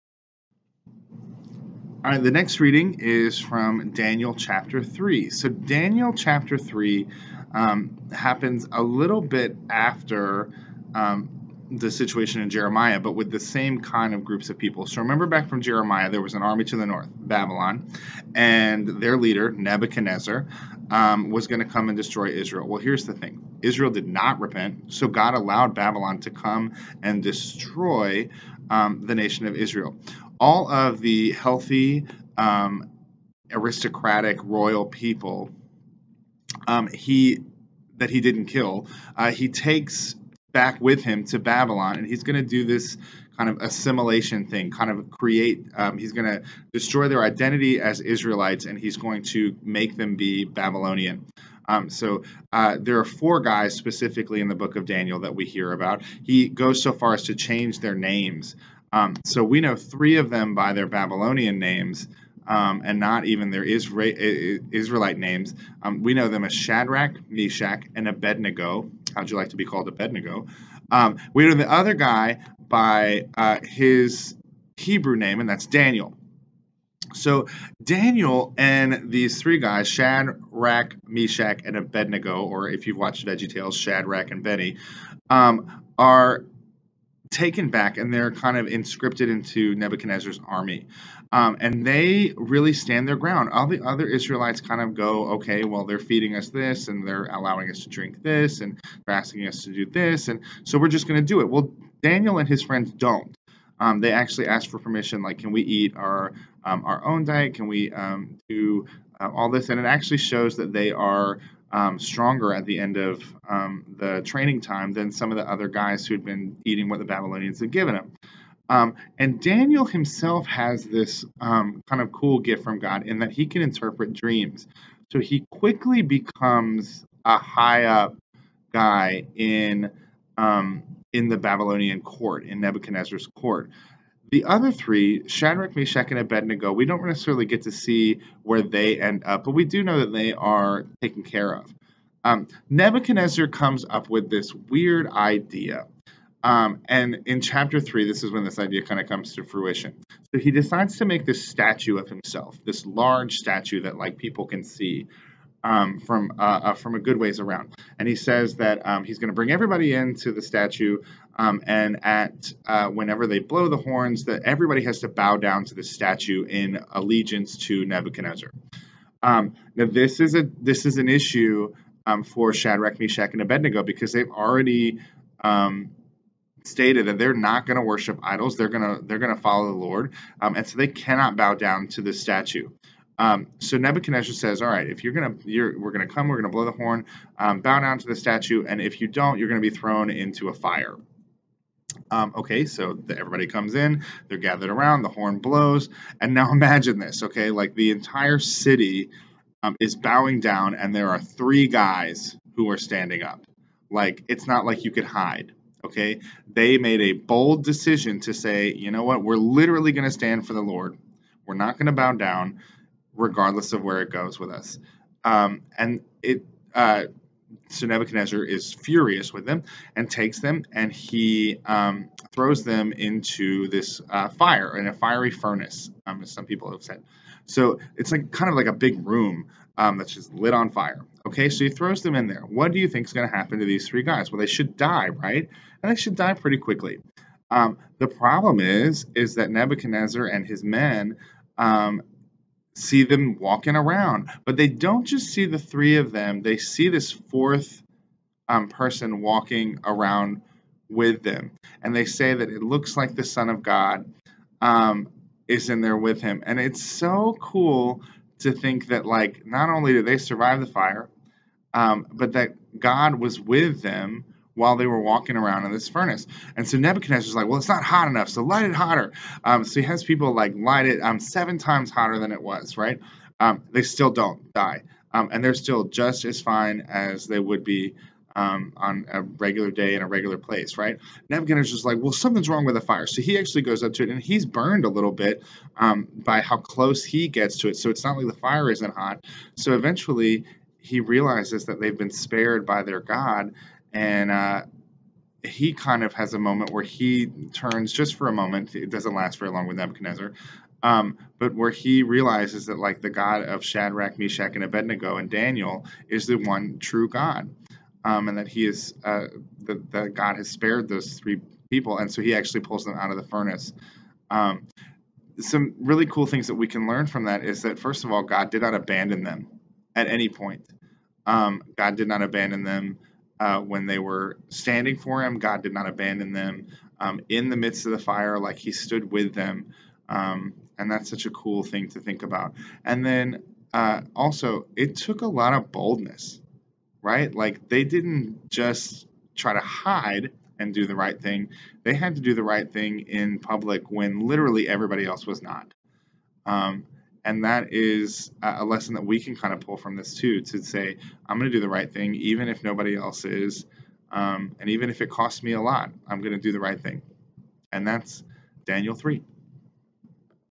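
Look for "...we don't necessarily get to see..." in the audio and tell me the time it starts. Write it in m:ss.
2:16.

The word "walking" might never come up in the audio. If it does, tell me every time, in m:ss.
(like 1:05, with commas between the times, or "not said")
4:03, 4:09, 4:24.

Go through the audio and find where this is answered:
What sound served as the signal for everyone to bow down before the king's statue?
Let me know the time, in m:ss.
2:43.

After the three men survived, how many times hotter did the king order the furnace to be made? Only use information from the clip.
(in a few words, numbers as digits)
7.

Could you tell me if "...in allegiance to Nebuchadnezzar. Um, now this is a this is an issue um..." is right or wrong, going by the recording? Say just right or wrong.
right.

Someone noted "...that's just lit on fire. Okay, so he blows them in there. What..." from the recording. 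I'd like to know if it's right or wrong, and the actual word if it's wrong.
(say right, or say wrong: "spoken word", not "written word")
wrong: "throws", not "blows".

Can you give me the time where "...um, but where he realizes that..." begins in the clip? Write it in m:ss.
5:00.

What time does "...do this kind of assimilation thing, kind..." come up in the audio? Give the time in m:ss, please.
0:42.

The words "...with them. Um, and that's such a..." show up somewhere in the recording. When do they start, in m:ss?
5:29.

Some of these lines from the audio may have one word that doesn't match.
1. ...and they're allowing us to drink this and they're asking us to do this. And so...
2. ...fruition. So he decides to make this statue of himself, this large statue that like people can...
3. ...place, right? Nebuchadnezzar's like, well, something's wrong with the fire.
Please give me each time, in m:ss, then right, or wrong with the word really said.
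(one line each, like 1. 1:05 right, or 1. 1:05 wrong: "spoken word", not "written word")
1. 1:36 right
2. 2:29 right
3. 4:40 right.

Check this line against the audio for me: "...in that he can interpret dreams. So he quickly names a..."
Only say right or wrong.
wrong.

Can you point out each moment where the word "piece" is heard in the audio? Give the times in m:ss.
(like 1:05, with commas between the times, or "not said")
not said.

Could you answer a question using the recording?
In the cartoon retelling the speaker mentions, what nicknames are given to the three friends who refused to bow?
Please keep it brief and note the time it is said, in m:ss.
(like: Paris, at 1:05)
Shack, Rack and Benny, at 1:23.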